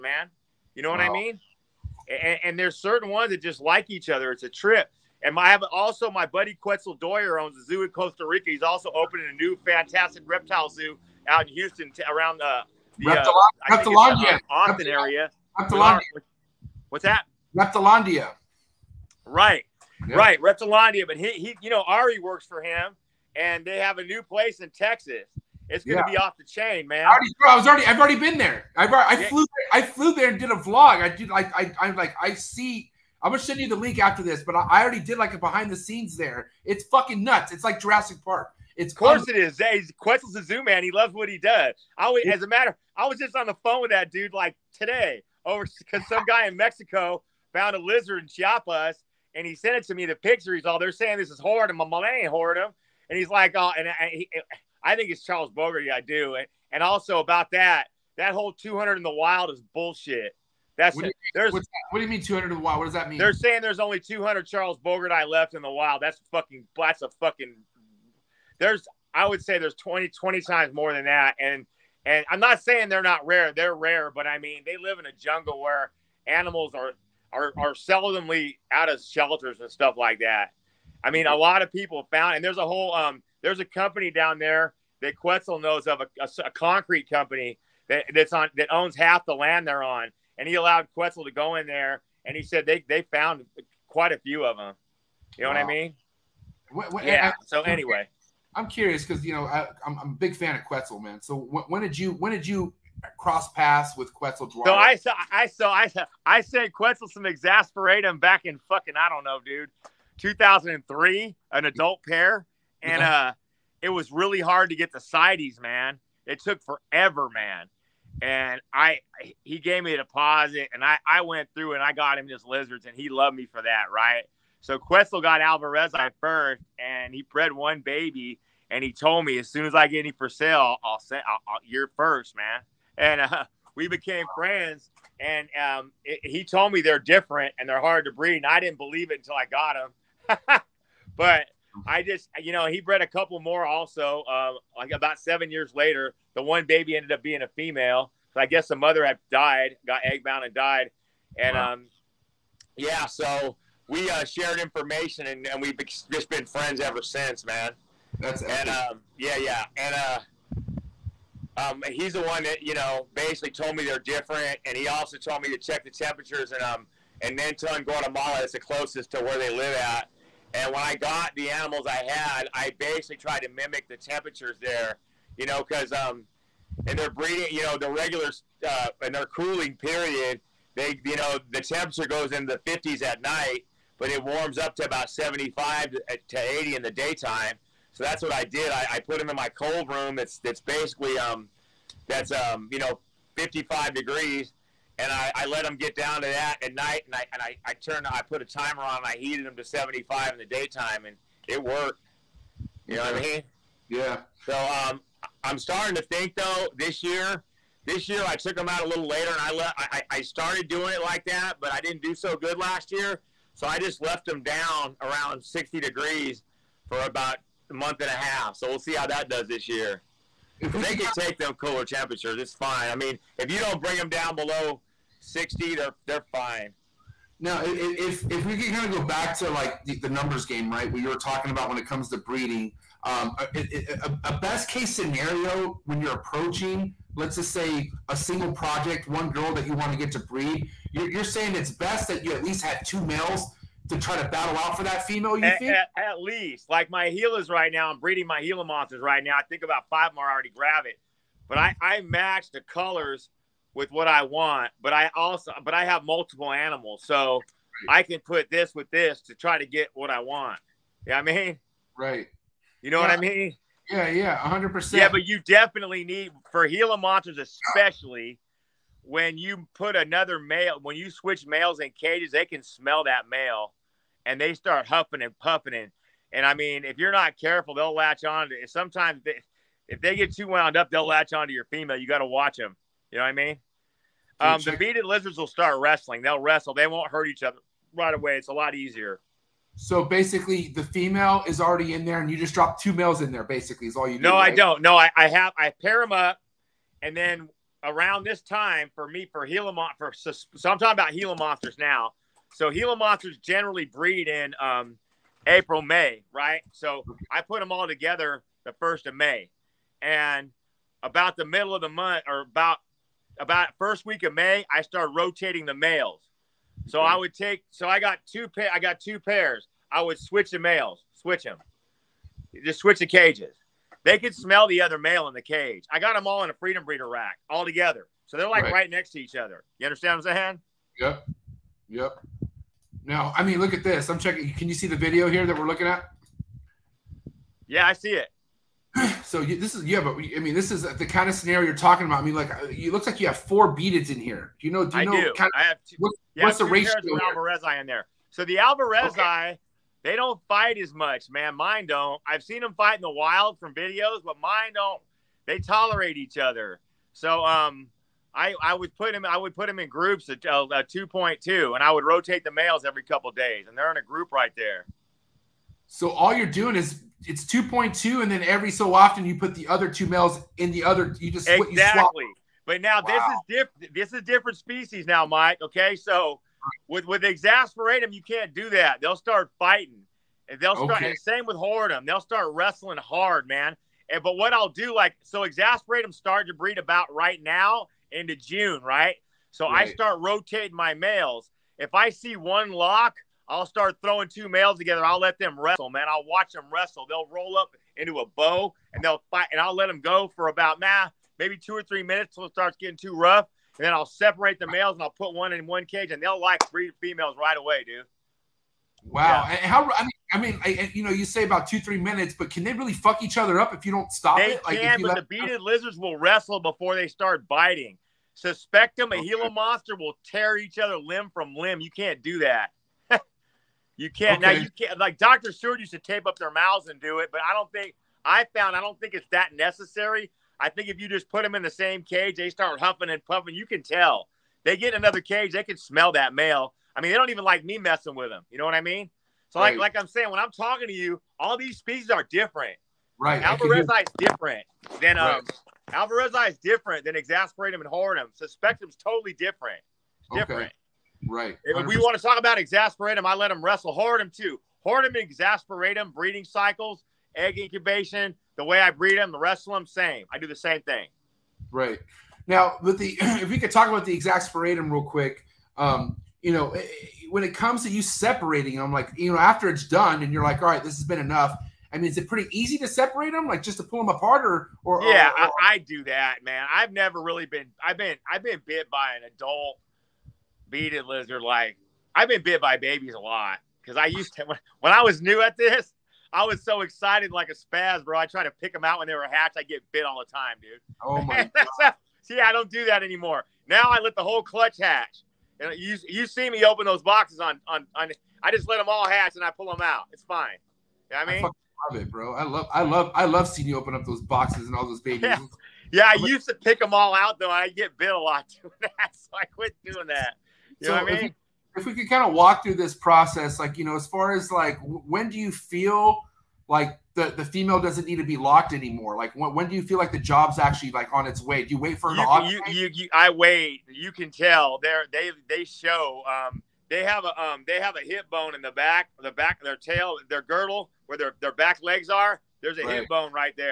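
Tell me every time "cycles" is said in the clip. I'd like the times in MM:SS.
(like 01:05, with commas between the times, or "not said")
07:36.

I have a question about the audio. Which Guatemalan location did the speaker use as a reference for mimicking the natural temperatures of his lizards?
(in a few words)
Nenton.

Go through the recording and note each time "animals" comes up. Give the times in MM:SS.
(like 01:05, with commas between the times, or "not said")
01:16, 02:51, 04:16.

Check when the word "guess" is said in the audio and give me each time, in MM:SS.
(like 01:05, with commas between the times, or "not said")
02:28.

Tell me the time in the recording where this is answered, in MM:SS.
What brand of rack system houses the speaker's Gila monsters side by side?
05:26.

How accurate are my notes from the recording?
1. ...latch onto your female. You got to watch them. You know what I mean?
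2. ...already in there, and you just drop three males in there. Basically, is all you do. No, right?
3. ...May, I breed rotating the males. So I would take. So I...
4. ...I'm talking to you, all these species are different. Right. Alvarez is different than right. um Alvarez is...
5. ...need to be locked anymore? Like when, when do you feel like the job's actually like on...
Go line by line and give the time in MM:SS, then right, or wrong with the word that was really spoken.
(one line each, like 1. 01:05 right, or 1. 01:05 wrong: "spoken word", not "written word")
1. 04:41 right
2. 04:51 wrong: "two", not "three"
3. 05:14 wrong: "started", not "breed"
4. 07:20 right
5. 08:38 right.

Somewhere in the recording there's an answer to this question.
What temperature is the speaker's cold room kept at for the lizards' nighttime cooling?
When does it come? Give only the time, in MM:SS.
03:13.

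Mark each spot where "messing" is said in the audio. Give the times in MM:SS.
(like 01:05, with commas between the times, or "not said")
07:17.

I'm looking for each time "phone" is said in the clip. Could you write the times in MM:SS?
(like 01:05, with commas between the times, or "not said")
00:43.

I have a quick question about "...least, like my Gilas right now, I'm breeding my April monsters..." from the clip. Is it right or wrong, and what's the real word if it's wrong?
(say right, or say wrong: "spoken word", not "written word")
wrong: "Gila", not "April".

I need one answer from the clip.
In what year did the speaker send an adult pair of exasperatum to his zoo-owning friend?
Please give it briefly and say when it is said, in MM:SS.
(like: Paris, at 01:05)
2003, at 01:50.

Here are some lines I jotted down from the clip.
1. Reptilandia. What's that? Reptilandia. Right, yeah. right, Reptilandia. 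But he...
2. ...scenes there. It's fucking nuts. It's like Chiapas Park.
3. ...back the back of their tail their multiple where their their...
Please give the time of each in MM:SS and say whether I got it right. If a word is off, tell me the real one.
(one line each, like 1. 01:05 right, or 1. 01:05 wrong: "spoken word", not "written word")
1. 00:15 right
2. 00:35 wrong: "Jurassic", not "Chiapas"
3. 08:48 wrong: "girdle", not "multiple".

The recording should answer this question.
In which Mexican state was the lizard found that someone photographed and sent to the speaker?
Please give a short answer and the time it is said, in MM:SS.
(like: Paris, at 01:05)
Chiapas, at 00:48.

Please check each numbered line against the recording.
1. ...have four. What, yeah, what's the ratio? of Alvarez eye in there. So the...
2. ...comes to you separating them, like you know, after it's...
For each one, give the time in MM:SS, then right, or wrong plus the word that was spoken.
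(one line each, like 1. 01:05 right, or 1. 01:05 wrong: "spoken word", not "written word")
1. 05:45 wrong: "two", not "four"
2. 07:47 right.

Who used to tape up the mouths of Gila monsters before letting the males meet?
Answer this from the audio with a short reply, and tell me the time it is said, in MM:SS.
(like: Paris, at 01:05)
Dr. Stewart, at 07:05.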